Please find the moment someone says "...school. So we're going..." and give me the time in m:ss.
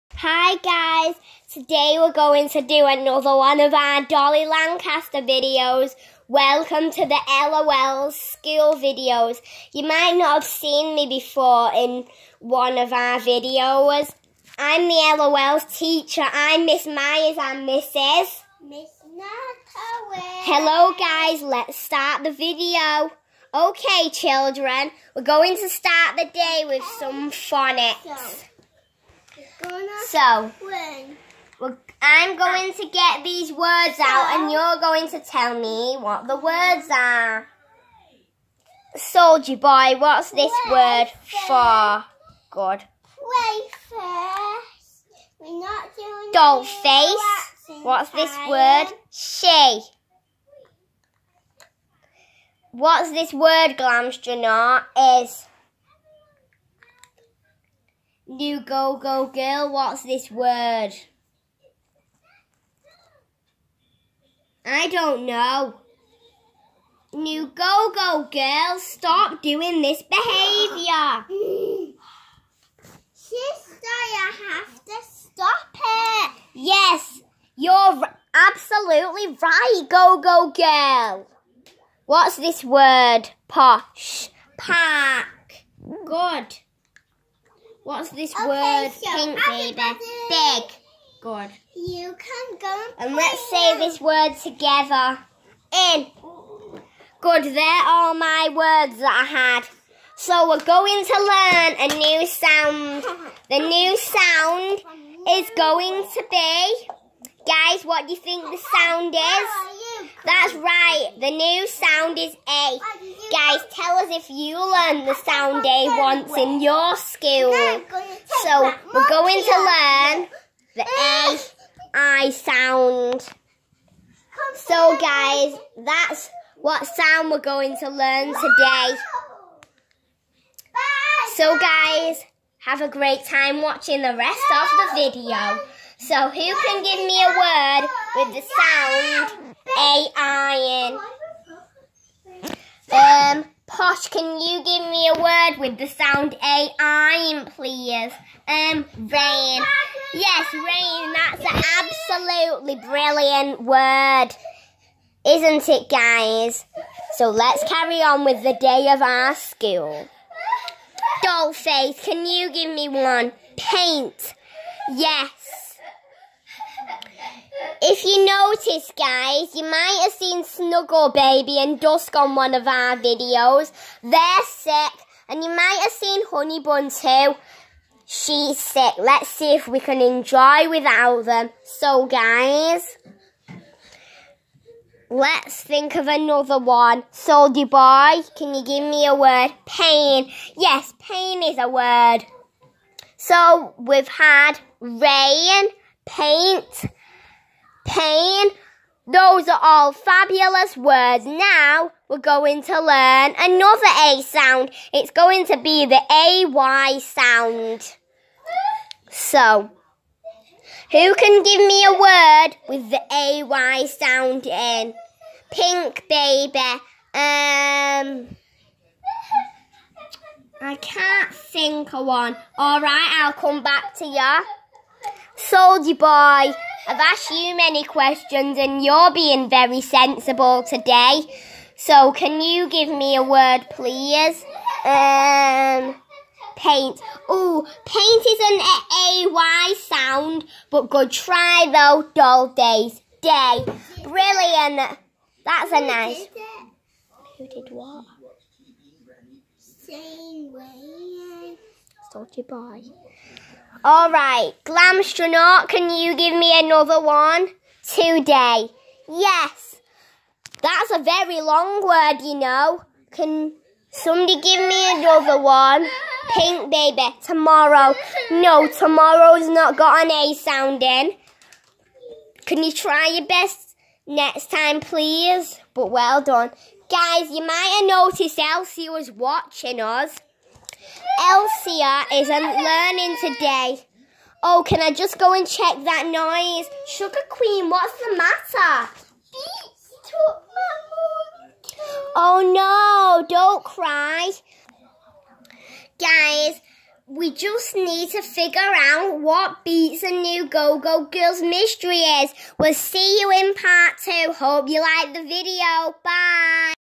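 1:56.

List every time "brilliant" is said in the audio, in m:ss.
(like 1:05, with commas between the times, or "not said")
2:32, 4:04.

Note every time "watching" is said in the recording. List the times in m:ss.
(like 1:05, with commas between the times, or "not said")
2:13, 4:39.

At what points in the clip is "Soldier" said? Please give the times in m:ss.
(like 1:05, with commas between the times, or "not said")
0:38, 3:07, 3:45.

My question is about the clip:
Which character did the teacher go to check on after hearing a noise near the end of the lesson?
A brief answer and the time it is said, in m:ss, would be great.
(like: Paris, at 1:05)
Sugar Queen, at 4:46.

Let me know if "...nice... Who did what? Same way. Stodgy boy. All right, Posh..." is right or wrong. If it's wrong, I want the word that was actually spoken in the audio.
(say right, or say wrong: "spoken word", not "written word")
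wrong: "Glamstronaut", not "Posh".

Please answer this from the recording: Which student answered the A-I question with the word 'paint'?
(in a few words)
Dollface.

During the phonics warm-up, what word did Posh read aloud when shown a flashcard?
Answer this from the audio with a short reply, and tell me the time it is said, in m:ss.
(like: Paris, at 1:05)
Pack, at 1:24.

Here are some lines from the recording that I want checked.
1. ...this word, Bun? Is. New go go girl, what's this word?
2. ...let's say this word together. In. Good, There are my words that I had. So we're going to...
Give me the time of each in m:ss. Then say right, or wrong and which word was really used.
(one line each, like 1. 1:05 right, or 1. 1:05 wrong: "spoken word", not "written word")
1. 0:53 wrong: "Glamstronaut", not "Bun"
2. 1:33 right.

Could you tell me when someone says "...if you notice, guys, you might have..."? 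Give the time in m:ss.
2:47.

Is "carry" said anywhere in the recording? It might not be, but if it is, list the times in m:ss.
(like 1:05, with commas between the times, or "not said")
2:37.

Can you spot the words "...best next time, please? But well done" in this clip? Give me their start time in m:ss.
4:33.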